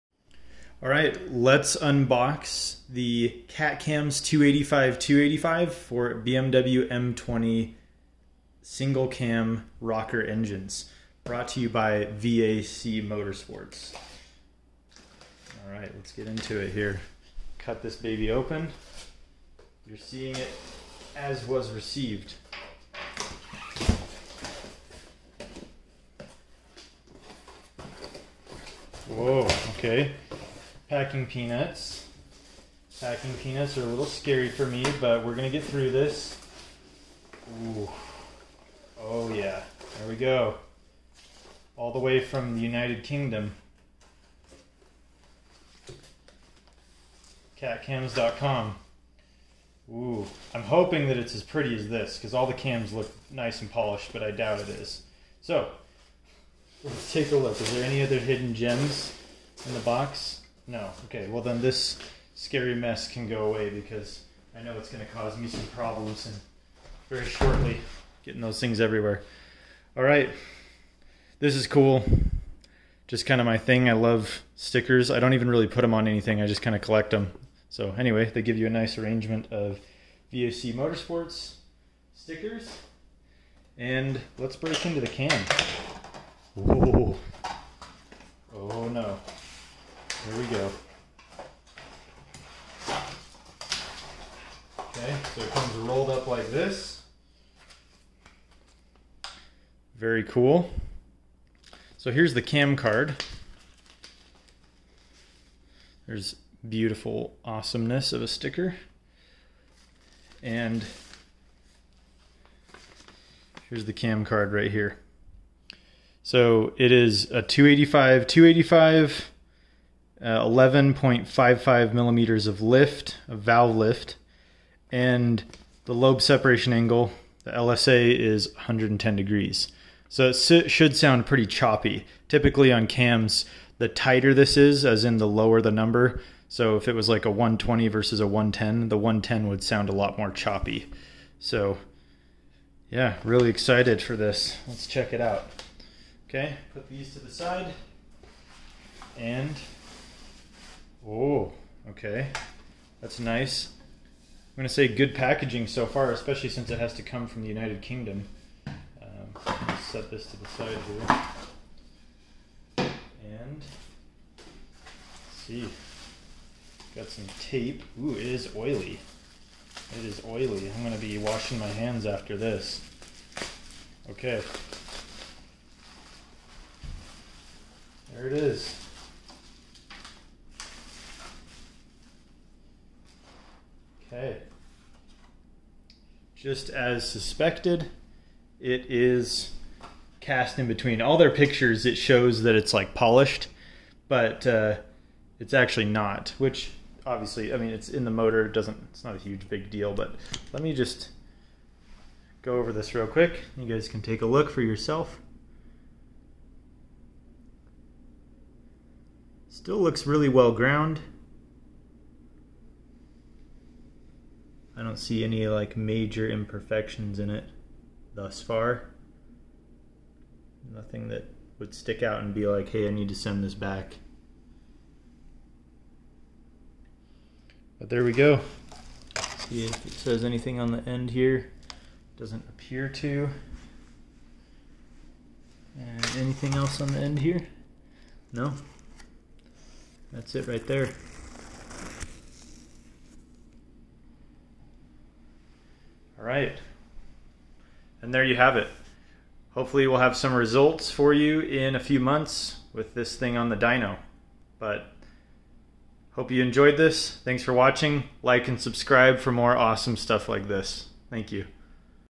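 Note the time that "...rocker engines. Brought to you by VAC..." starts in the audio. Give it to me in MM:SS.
00:09.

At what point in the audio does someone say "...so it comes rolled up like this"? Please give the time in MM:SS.
01:35.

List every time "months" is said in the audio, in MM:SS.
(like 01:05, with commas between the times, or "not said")
04:11.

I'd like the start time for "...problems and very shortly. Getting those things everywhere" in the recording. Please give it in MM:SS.
01:05.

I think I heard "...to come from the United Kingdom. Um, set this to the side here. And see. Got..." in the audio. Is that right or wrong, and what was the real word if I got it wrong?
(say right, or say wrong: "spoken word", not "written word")
right.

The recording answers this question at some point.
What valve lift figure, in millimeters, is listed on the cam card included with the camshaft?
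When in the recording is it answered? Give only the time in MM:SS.
02:00.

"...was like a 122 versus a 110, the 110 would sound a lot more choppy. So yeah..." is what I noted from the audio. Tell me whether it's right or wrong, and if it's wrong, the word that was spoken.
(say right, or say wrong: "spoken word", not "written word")
wrong: "120", not "122".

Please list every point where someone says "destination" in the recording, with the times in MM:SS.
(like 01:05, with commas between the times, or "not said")
not said.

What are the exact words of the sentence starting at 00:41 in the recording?
All the way from the United Kingdom.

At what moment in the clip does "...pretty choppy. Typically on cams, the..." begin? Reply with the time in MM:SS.
02:11.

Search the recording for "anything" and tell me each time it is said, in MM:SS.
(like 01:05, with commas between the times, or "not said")
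01:16, 03:50, 03:56.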